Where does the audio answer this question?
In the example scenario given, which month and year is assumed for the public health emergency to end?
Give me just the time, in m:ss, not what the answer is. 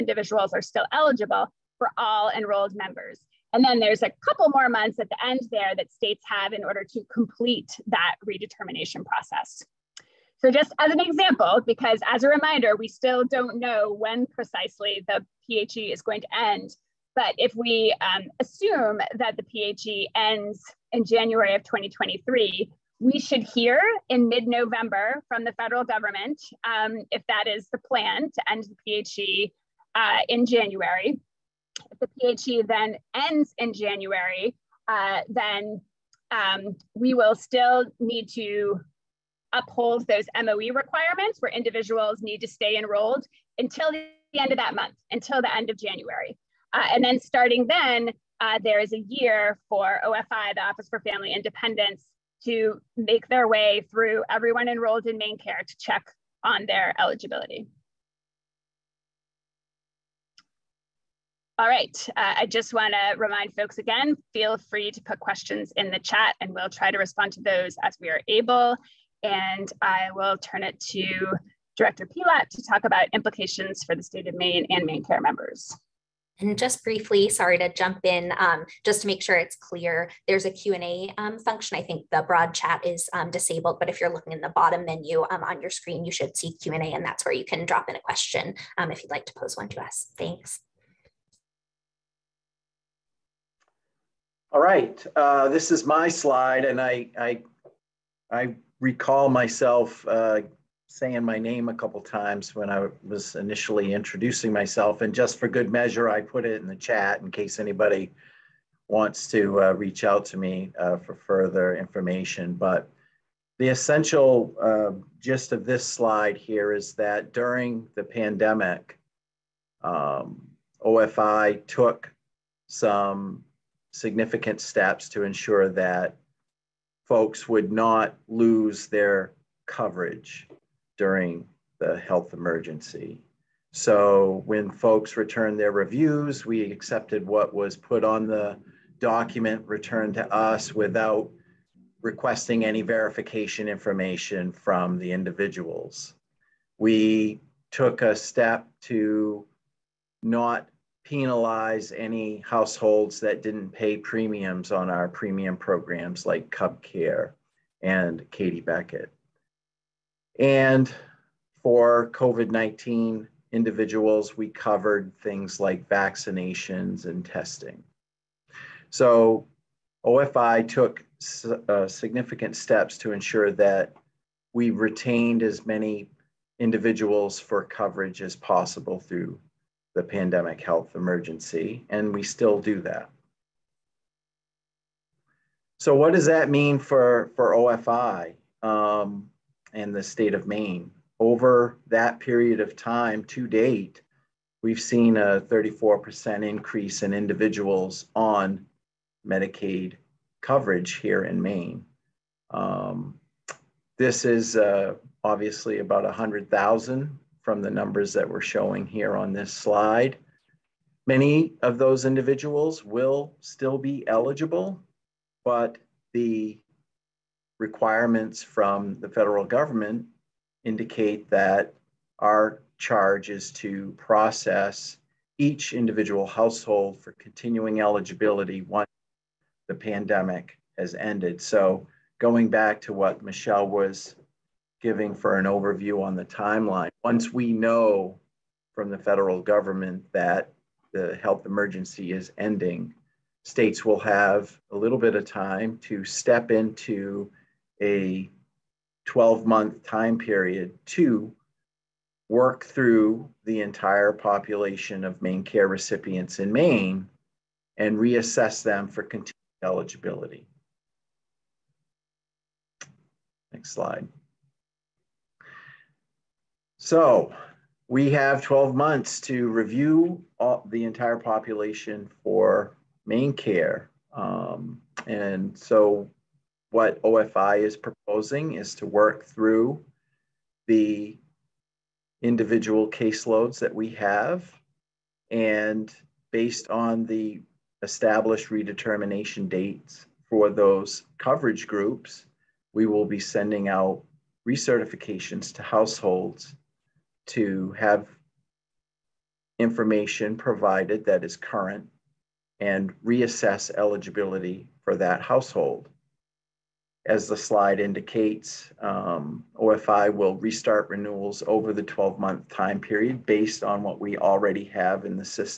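0:21.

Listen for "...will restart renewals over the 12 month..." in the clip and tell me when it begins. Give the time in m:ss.
5:10.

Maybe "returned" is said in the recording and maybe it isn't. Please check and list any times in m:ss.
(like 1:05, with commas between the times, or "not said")
2:15, 2:19.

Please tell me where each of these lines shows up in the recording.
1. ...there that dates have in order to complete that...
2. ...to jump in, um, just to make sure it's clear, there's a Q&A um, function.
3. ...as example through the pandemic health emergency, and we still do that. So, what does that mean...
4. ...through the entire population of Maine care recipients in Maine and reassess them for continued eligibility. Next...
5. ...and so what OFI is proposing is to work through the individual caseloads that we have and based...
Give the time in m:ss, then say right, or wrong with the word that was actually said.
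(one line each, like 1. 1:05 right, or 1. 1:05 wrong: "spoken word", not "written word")
1. 0:05 wrong: "states", not "dates"
2. 1:17 right
3. 2:58 wrong: "possible", not "example"
4. 4:12 right
5. 4:35 right.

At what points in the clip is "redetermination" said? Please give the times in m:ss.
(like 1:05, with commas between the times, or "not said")
0:08, 4:48.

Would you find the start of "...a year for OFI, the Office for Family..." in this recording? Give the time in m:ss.
0:48.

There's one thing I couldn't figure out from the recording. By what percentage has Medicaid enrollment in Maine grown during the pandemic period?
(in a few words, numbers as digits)
34%.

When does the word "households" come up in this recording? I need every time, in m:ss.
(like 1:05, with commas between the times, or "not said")
2:32, 3:46, 4:55, 5:05.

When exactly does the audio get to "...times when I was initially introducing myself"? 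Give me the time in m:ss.
1:42.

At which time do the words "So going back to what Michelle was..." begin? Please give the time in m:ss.
3:51.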